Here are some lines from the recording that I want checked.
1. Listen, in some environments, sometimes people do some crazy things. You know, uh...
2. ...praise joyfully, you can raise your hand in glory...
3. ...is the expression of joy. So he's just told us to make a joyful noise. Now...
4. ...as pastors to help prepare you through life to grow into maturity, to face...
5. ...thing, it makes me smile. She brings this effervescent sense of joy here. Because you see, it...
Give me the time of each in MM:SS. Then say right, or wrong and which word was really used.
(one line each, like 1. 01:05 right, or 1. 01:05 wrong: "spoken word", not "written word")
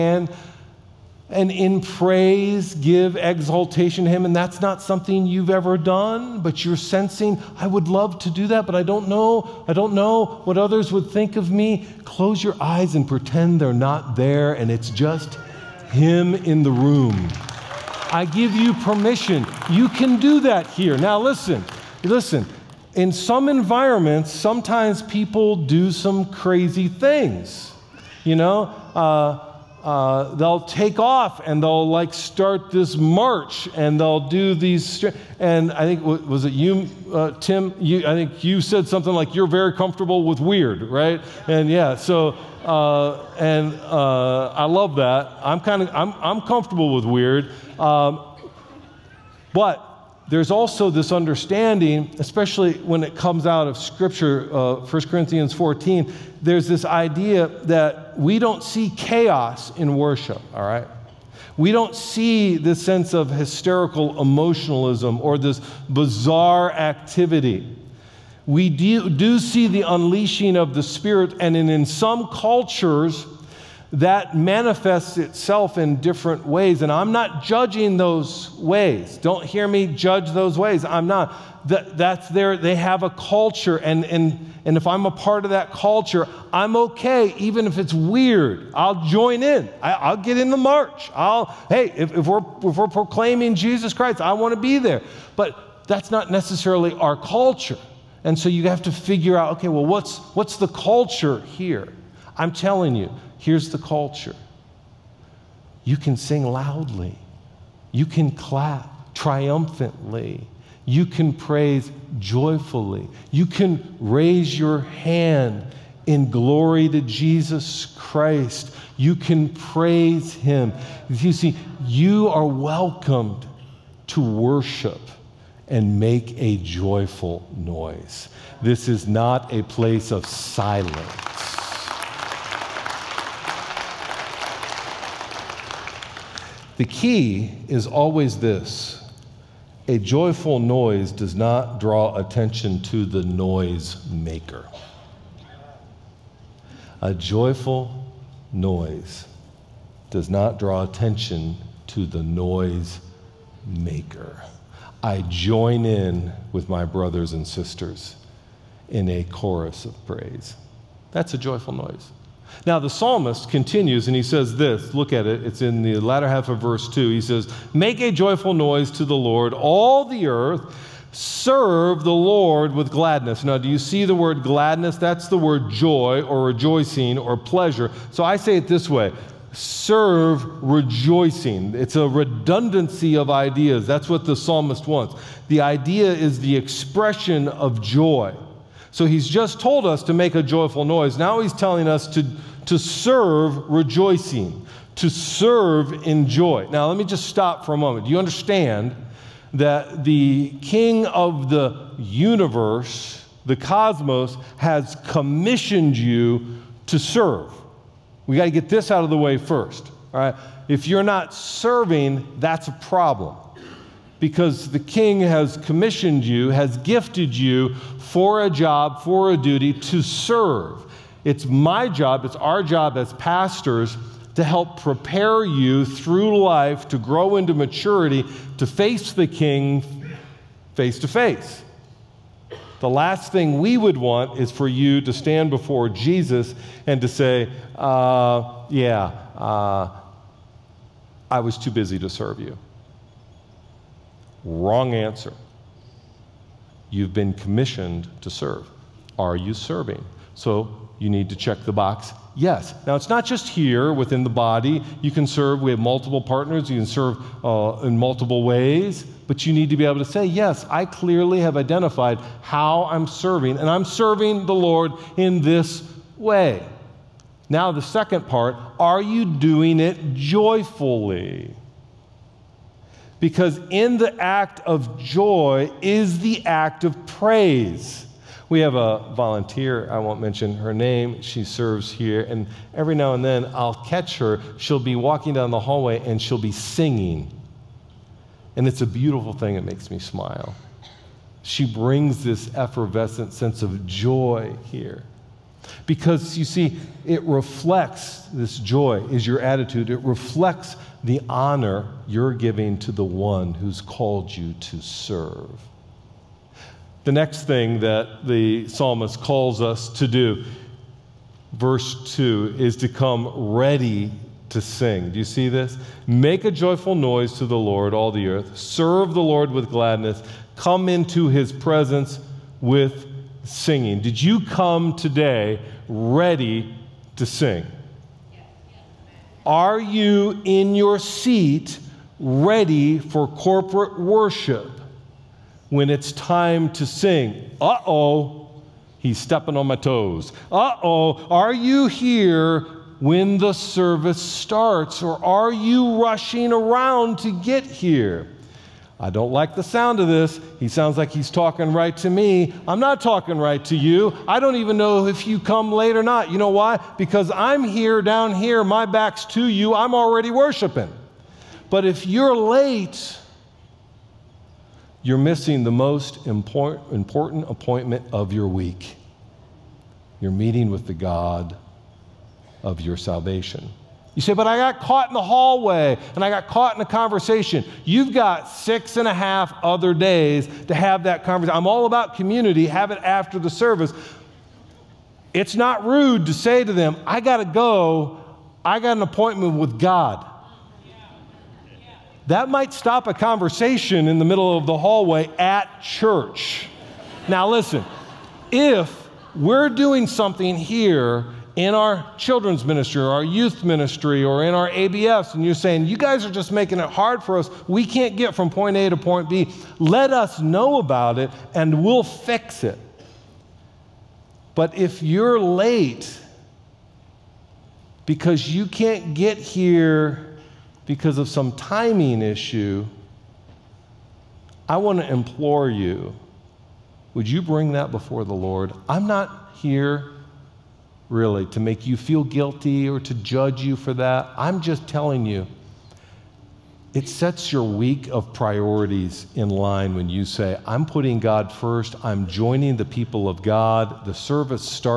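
1. 00:22 right
2. 01:51 right
3. 03:06 right
4. 03:42 right
5. 04:49 right.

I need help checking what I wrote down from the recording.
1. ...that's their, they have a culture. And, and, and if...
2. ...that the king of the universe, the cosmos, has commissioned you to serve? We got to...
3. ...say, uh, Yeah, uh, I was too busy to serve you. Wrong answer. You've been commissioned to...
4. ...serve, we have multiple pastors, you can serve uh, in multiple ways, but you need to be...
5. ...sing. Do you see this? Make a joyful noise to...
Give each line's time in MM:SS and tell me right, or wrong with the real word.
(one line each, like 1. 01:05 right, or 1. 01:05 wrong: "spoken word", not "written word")
1. 01:21 right
2. 03:19 right
3. 03:57 right
4. 04:15 wrong: "partners", not "pastors"
5. 05:14 right.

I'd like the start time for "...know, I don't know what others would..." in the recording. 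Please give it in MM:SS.
00:09.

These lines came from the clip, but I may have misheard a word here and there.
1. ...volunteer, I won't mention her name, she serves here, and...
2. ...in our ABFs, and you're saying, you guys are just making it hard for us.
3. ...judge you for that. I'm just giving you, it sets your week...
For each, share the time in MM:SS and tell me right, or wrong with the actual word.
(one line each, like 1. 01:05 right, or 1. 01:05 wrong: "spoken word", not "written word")
1. 04:39 right
2. 06:44 right
3. 07:13 wrong: "telling", not "giving".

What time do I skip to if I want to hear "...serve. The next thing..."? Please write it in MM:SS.
05:04.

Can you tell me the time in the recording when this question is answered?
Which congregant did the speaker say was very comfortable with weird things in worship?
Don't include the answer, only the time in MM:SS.
00:37.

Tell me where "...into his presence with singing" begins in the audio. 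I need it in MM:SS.
05:20.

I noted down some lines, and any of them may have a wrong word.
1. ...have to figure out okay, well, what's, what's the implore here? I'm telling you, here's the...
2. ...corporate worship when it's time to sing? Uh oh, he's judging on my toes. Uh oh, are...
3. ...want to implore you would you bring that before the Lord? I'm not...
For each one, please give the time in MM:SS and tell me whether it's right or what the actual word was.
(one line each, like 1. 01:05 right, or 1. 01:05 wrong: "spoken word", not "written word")
1. 01:38 wrong: "culture", not "implore"
2. 05:33 wrong: "stepping", not "judging"
3. 07:04 right.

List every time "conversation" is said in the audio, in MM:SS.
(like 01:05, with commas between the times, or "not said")
06:16, 06:21, 06:33.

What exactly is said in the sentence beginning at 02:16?
The key is always this a joyful noise does not draw attention to the noise maker.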